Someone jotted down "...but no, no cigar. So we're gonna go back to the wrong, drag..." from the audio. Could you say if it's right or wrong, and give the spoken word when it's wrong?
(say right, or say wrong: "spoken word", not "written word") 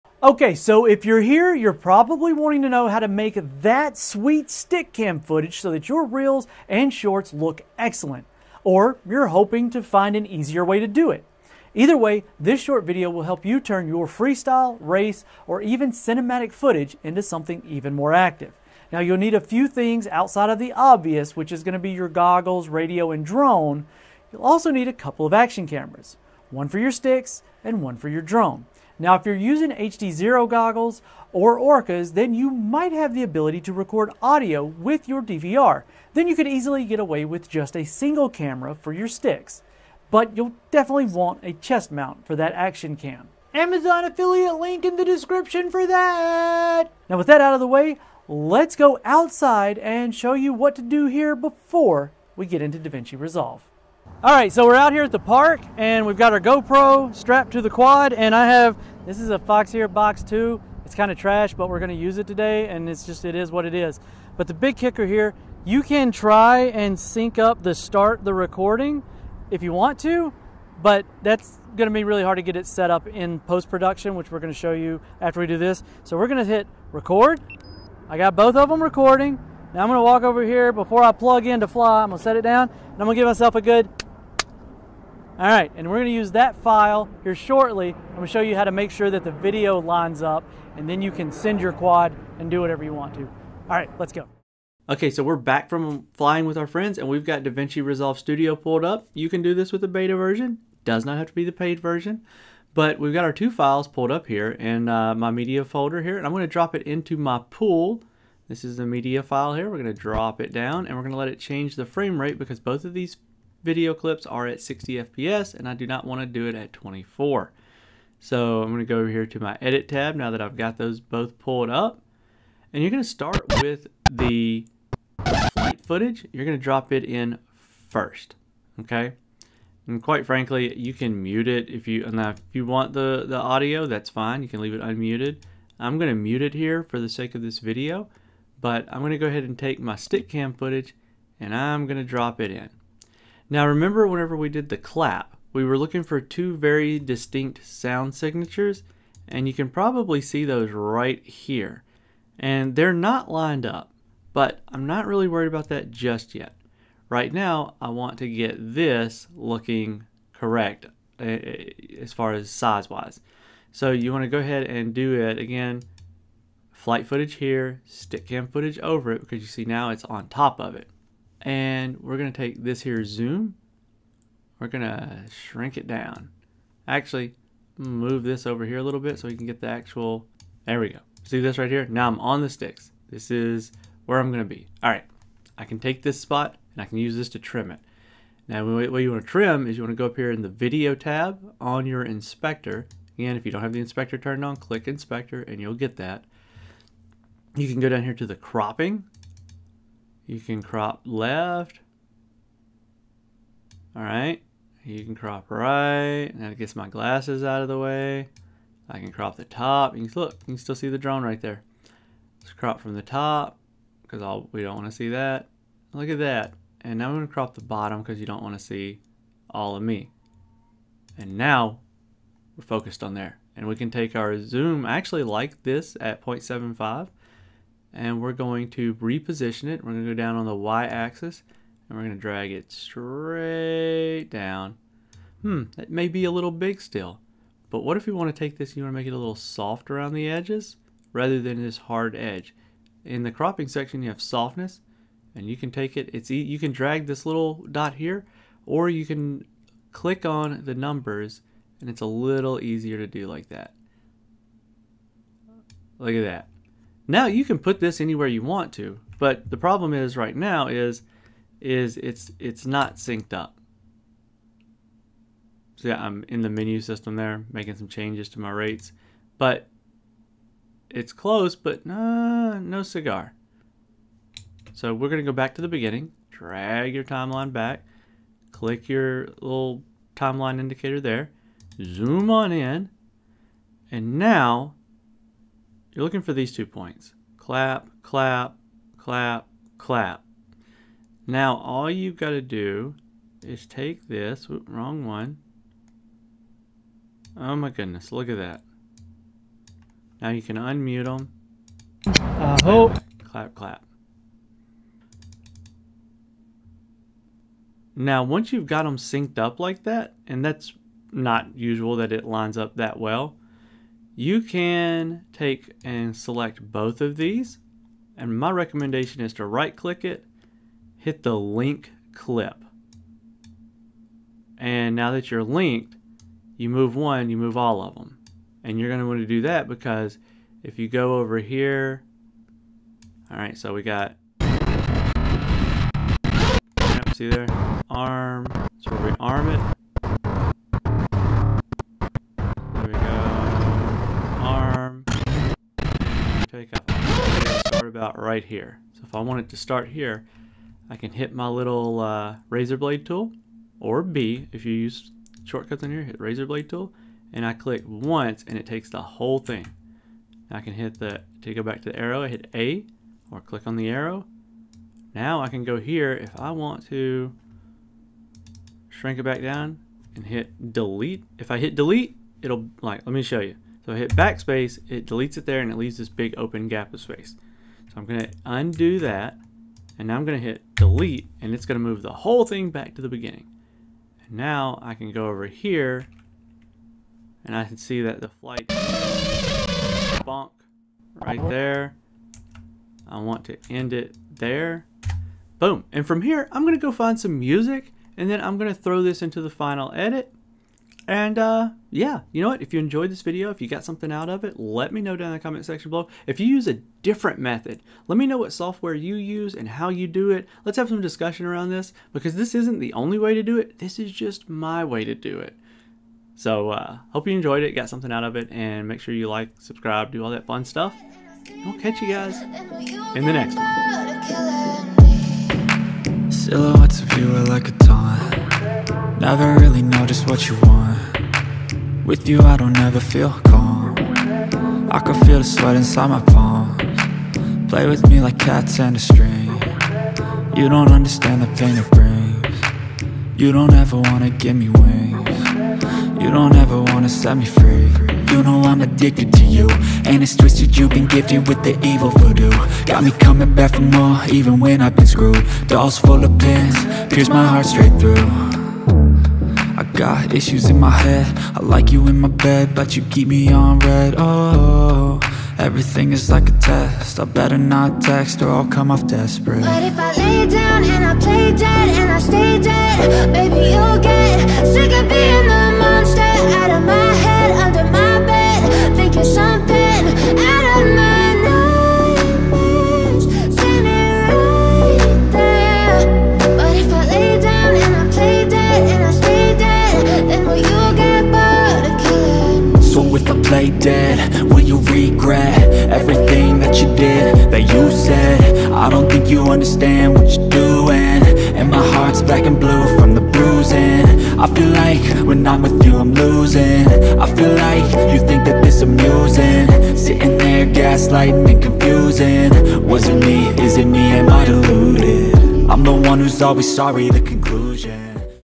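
wrong: "beginning", not "wrong".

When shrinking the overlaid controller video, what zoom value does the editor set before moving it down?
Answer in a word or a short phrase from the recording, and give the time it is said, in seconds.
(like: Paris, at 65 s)
0.75, at 226 s.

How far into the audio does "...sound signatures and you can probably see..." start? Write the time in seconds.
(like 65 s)
147 s.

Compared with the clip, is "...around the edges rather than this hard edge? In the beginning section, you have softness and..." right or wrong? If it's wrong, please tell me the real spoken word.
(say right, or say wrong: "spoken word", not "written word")
wrong: "cropping", not "beginning".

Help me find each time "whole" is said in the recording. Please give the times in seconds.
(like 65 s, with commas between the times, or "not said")
359 s, 382 s.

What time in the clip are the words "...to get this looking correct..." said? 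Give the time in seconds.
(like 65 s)
158 s.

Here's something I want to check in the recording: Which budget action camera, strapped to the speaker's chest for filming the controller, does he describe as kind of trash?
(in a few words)
Foxeer Box 2.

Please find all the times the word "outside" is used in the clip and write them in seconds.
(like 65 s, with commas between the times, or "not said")
20 s, 49 s.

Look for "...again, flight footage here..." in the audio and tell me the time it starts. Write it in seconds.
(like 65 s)
165 s.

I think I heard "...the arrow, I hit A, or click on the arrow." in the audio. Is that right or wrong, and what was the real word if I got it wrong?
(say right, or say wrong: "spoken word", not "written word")
right.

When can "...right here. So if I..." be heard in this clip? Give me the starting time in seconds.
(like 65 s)
348 s.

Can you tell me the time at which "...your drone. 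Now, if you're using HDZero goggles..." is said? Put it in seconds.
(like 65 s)
28 s.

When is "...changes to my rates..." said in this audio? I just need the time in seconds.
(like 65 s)
267 s.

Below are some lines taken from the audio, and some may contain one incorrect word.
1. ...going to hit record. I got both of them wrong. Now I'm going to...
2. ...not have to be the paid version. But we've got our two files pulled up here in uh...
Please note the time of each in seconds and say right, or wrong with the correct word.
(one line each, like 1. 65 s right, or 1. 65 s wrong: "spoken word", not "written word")
1. 76 s wrong: "recording", not "wrong"
2. 101 s right.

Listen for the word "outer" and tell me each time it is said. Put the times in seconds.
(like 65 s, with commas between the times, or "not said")
not said.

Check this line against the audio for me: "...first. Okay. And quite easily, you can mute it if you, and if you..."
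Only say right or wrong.
wrong.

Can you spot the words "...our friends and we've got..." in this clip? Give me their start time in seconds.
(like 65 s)
96 s.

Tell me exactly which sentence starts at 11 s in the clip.
Either way, this short video will help you turn your freestyle, race, or even cinematic footage into something even more active.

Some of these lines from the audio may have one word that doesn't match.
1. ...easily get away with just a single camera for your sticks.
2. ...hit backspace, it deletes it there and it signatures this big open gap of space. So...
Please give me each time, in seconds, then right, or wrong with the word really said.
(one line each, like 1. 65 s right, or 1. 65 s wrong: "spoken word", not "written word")
1. 36 s right
2. 373 s wrong: "leaves", not "signatures".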